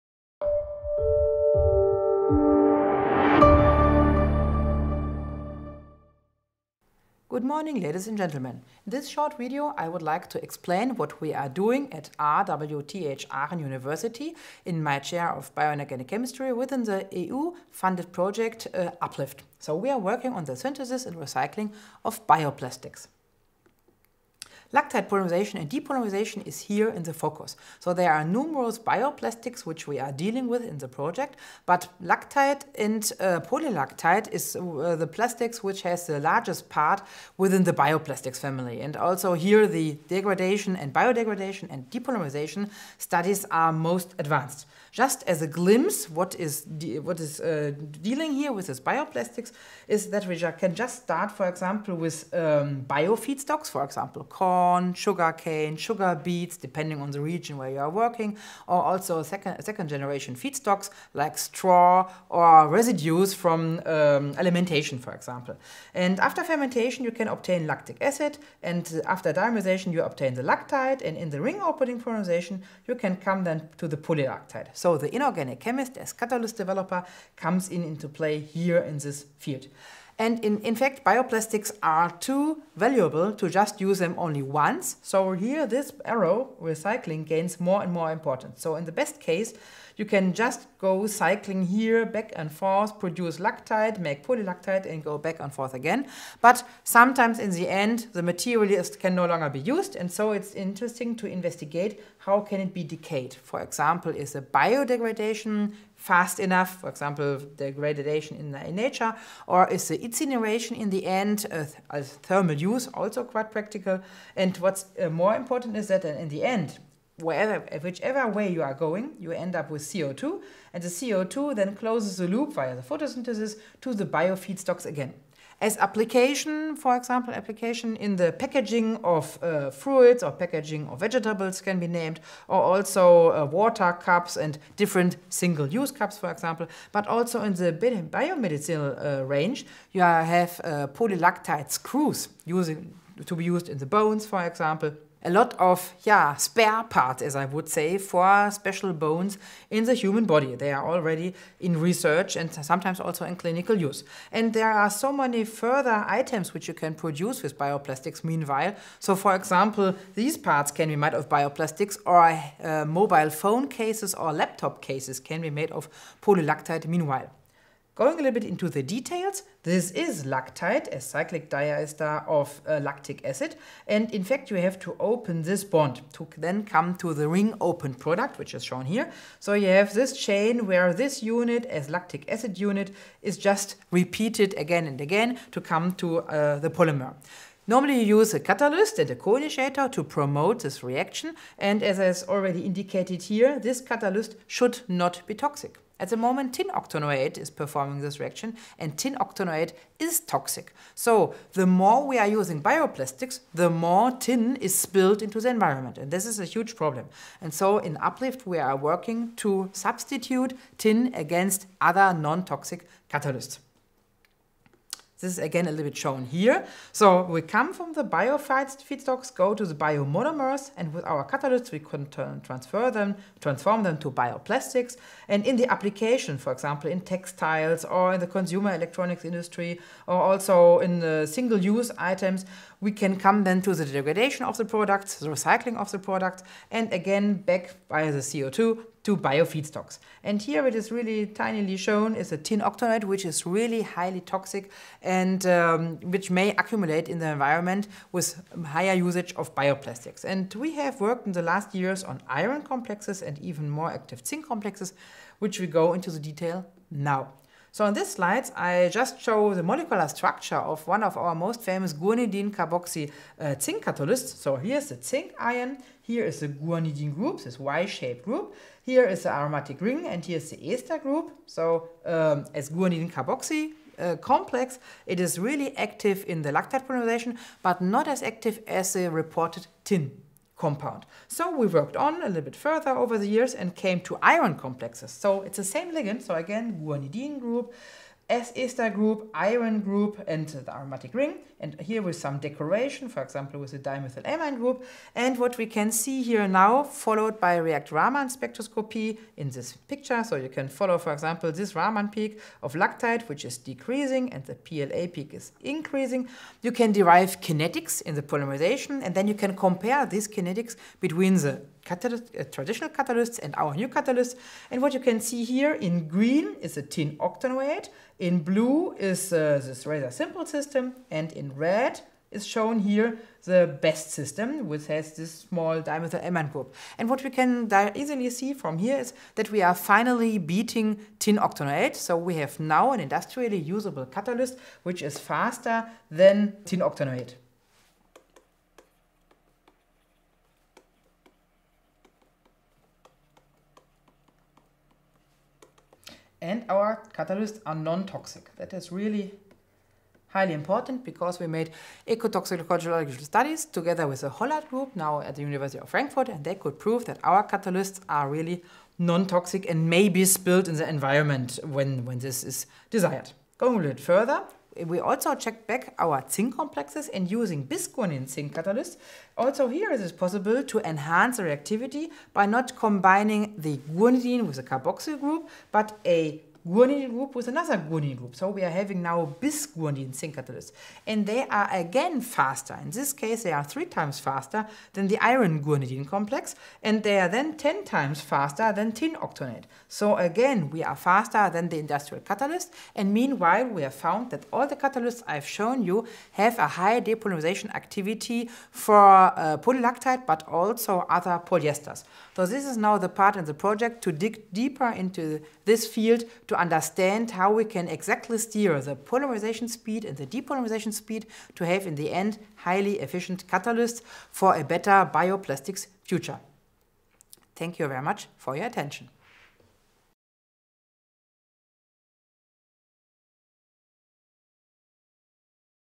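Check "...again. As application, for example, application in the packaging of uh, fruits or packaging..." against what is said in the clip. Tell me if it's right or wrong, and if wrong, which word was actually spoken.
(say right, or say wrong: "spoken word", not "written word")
right.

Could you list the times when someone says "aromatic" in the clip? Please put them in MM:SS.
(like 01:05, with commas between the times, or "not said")
04:29, 04:50.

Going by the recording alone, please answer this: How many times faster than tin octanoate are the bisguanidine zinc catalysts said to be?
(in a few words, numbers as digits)
10.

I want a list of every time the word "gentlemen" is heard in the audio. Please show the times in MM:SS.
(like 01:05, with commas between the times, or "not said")
00:08.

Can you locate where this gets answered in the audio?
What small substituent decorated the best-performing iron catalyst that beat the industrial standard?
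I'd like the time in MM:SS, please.
04:53.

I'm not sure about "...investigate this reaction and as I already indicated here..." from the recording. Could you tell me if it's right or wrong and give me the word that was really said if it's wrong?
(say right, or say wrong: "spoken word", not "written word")
wrong: "promote", not "investigate".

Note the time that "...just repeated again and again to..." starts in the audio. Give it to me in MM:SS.
03:03.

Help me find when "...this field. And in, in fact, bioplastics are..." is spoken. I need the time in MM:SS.
01:18.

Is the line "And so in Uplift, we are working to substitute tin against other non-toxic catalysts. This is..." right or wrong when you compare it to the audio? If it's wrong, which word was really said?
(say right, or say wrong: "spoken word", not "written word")
right.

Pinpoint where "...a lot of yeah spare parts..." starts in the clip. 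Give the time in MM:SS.
02:25.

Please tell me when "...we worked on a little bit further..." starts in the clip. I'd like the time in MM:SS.
04:41.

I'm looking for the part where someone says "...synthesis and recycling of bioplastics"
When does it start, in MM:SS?
00:20.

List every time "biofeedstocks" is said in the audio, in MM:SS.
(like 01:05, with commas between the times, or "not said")
00:52, 02:04, 03:59.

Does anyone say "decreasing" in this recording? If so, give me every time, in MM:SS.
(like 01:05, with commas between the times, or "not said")
05:03.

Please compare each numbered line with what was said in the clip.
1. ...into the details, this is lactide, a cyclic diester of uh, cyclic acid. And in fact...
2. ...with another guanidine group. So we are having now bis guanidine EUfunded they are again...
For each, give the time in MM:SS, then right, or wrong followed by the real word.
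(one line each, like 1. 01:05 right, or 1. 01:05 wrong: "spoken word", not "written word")
1. 02:48 wrong: "lactic", not "cyclic"
2. 06:17 wrong: "And", not "EUfunded".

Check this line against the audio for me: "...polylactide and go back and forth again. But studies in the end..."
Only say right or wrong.
wrong.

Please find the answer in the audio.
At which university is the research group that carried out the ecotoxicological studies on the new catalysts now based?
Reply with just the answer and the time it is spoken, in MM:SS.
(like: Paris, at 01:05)
University of Frankfurt, at 05:55.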